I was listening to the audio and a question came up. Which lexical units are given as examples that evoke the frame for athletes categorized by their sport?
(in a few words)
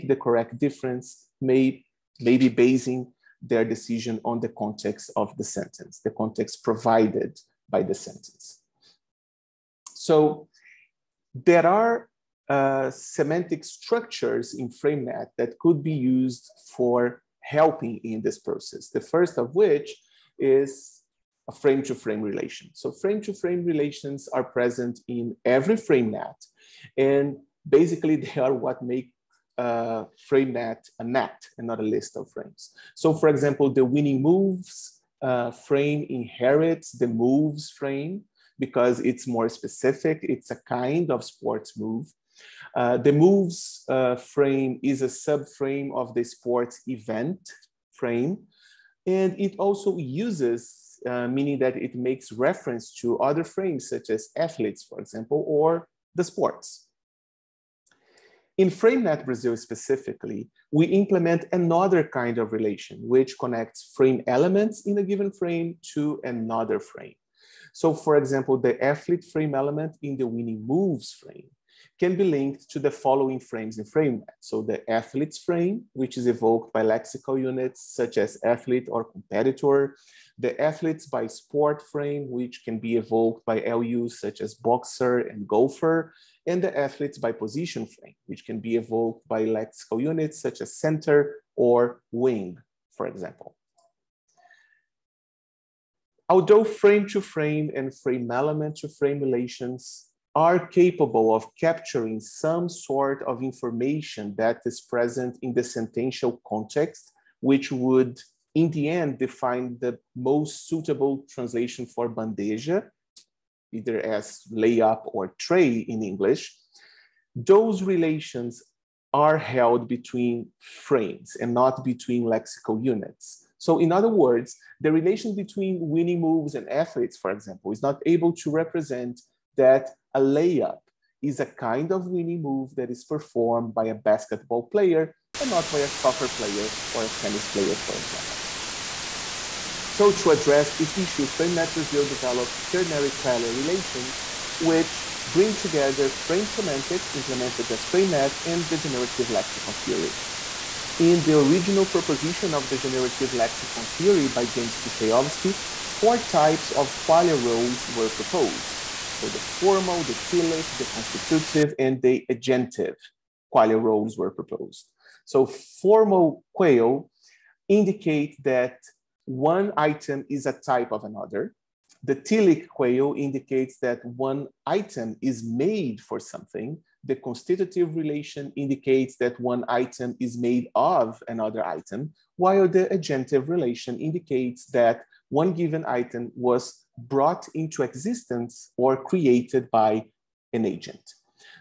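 boxer and golfer.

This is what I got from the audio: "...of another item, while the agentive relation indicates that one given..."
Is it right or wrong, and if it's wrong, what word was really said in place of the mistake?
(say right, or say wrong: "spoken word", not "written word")
right.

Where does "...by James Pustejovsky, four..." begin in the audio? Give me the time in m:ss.
2:34.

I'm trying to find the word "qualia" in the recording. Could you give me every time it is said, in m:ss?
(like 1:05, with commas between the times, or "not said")
2:23, 2:37, 2:43.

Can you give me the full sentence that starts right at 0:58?
In FrameNet Brazil specifically, we implement another kind of relation, which connects frame elements in a given frame to another frame.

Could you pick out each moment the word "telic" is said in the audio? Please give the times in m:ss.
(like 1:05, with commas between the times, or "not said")
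2:40, 2:52.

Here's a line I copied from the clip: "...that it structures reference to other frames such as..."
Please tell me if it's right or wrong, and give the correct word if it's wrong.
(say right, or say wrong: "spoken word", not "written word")
wrong: "makes", not "structures".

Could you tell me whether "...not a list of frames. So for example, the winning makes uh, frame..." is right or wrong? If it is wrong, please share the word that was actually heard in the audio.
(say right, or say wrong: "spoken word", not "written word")
wrong: "moves", not "makes".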